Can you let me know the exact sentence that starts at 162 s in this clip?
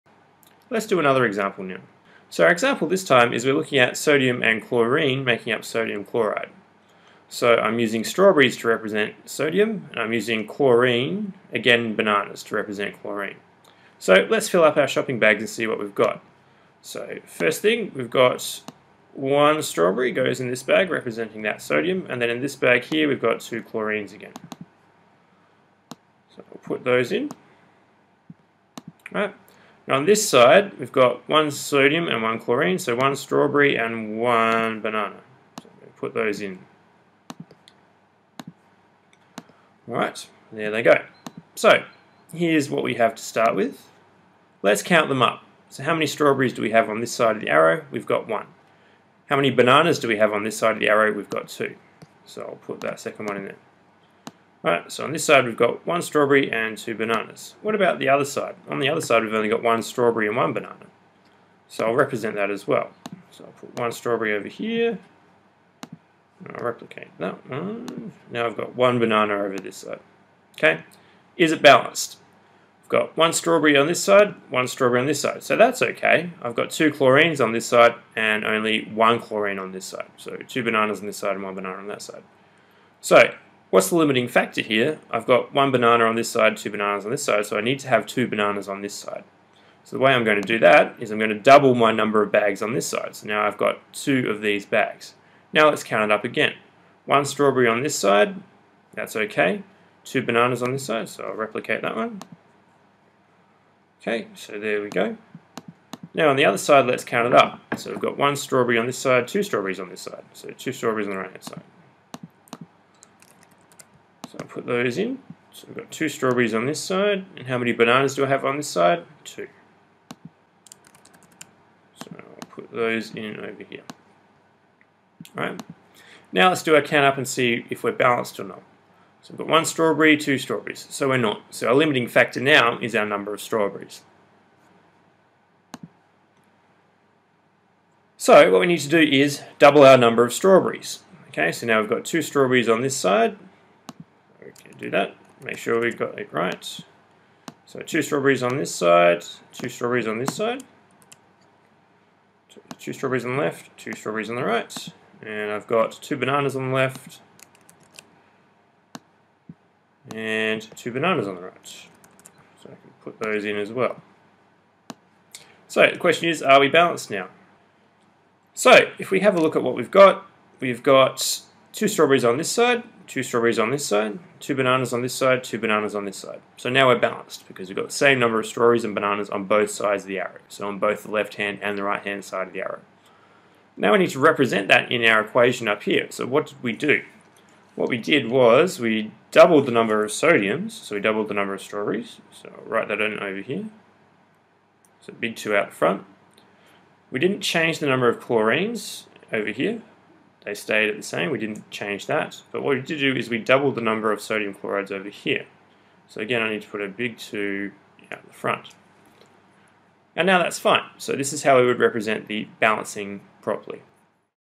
So I can put those in as well.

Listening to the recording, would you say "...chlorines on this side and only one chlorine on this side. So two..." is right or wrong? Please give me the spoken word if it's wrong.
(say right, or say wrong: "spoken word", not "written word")
right.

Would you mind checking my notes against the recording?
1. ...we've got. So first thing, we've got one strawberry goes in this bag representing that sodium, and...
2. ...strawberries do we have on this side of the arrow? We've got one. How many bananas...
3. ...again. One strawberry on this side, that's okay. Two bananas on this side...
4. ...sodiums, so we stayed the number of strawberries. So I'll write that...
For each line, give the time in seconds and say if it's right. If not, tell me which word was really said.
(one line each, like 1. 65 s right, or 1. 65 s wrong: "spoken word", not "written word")
1. 15 s right
2. 46 s right
3. 96 s right
4. 190 s wrong: "doubled", not "stayed".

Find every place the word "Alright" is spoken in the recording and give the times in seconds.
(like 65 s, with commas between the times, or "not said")
39 s, 54 s.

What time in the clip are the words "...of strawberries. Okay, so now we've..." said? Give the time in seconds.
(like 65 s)
140 s.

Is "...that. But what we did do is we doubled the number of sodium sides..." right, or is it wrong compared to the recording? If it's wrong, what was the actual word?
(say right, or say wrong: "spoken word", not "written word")
wrong: "chlorides", not "sides".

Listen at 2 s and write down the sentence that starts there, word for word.
So our example this time is we're looking at sodium and chlorine making up sodium chloride.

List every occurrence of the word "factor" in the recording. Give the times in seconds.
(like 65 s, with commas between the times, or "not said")
84 s, 132 s.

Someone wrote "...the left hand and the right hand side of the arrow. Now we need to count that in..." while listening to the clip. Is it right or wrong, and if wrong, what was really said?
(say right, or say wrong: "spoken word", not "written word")
wrong: "represent", not "count".